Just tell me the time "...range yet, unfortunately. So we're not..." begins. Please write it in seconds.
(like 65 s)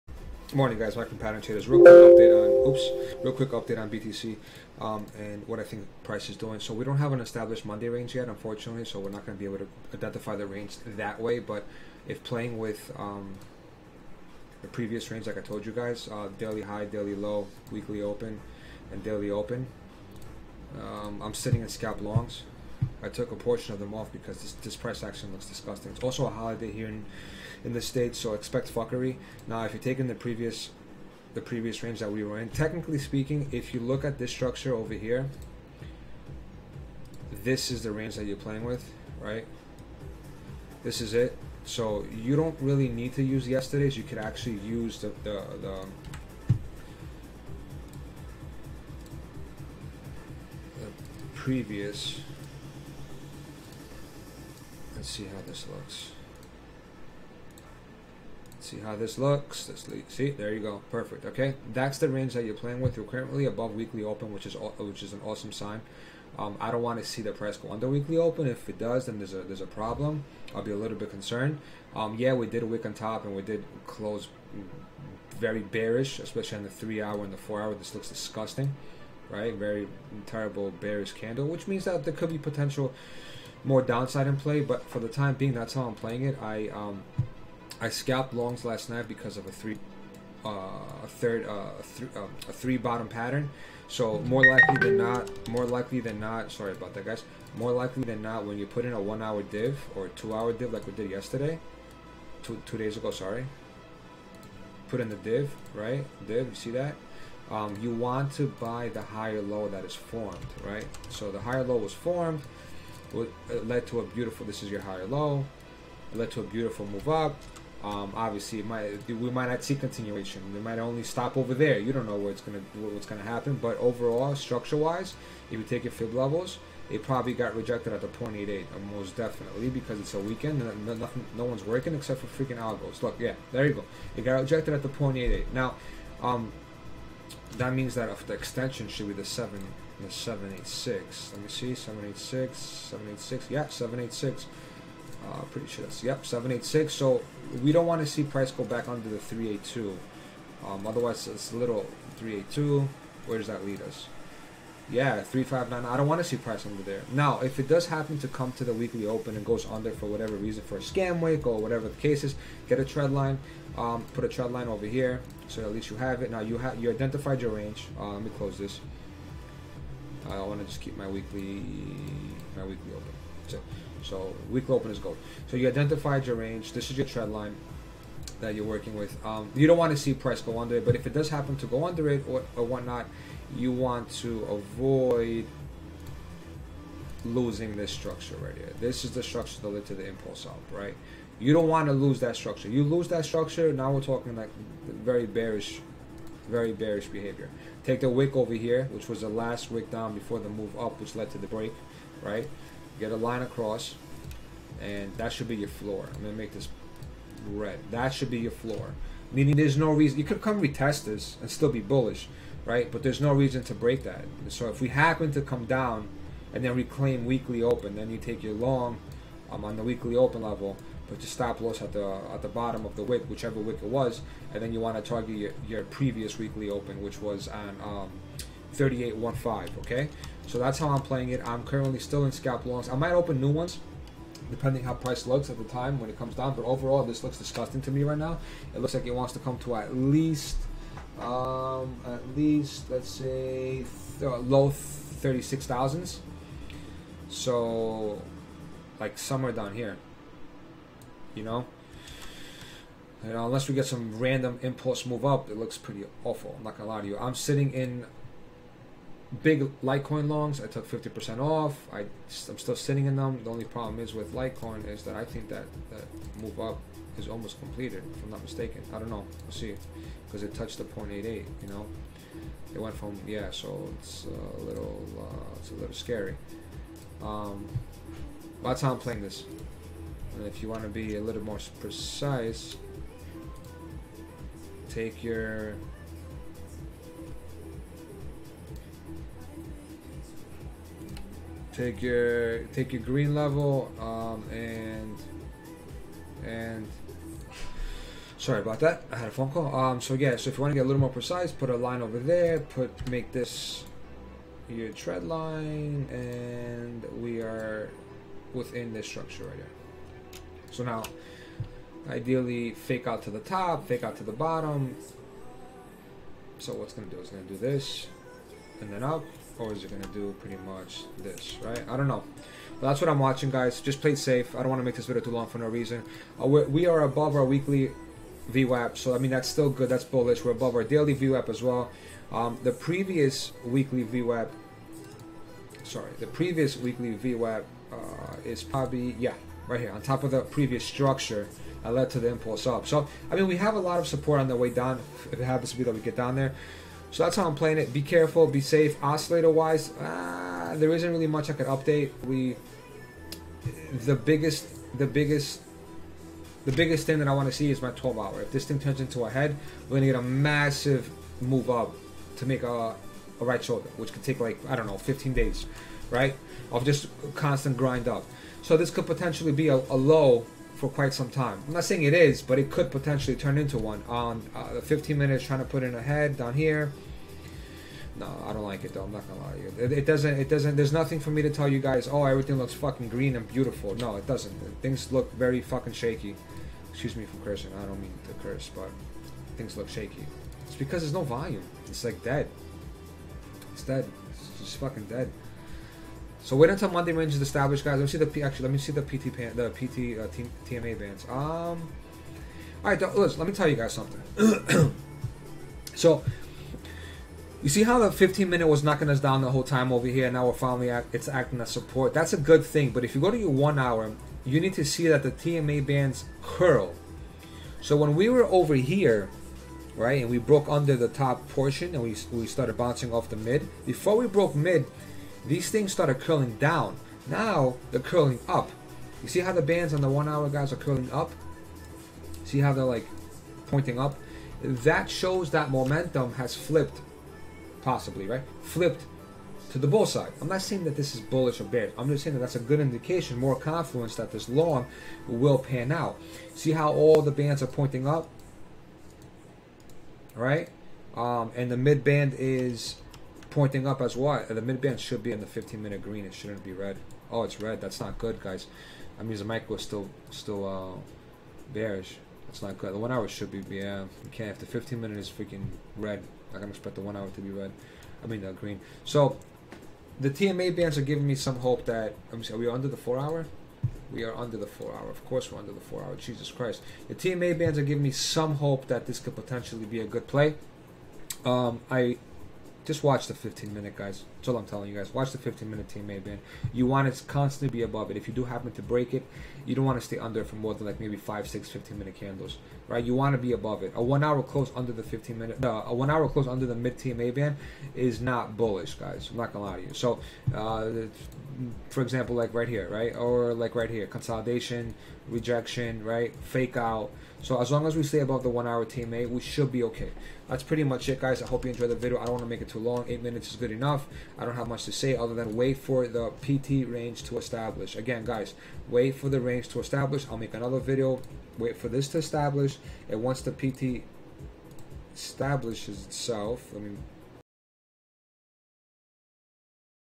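7 s.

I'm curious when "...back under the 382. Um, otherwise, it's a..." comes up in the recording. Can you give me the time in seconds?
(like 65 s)
148 s.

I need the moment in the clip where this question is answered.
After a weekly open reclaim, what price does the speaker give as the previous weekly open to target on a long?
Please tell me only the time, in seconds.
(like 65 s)
228 s.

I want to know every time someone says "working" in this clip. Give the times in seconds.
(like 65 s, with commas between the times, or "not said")
131 s, 178 s.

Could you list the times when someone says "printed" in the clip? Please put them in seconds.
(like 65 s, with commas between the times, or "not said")
not said.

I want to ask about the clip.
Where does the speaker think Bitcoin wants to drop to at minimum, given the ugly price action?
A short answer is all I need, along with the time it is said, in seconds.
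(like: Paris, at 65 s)
low 36 thousands, at 244 s.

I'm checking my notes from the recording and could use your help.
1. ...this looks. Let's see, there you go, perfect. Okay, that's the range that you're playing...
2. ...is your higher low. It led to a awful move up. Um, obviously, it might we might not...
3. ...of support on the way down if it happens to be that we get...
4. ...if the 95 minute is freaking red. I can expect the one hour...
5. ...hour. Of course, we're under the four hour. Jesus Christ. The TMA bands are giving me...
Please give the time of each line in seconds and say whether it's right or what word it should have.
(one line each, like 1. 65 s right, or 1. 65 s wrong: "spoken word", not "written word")
1. 58 s right
2. 114 s wrong: "beautiful", not "awful"
3. 343 s right
4. 464 s wrong: "15", not "95"
5. 474 s right.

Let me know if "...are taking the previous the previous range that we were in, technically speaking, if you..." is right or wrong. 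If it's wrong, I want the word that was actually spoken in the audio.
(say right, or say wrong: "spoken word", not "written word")
right.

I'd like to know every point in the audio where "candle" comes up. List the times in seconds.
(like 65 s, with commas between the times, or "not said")
81 s, 492 s.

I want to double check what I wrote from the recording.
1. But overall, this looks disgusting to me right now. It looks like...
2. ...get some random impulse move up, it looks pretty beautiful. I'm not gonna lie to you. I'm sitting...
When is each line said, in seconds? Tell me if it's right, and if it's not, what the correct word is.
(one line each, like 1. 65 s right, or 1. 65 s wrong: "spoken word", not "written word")
1. 236 s right
2. 253 s wrong: "awful", not "beautiful".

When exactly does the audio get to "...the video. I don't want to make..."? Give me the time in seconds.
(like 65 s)
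511 s.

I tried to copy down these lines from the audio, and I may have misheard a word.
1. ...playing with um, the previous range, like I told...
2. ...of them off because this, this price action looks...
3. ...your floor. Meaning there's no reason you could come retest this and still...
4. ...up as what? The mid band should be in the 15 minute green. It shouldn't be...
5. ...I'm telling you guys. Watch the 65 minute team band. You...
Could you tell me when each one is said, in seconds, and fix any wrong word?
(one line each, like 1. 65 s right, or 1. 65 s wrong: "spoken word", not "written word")
1. 12 s right
2. 23 s right
3. 208 s right
4. 453 s right
5. 484 s wrong: "15", not "65".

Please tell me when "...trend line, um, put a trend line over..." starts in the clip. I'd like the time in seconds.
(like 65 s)
162 s.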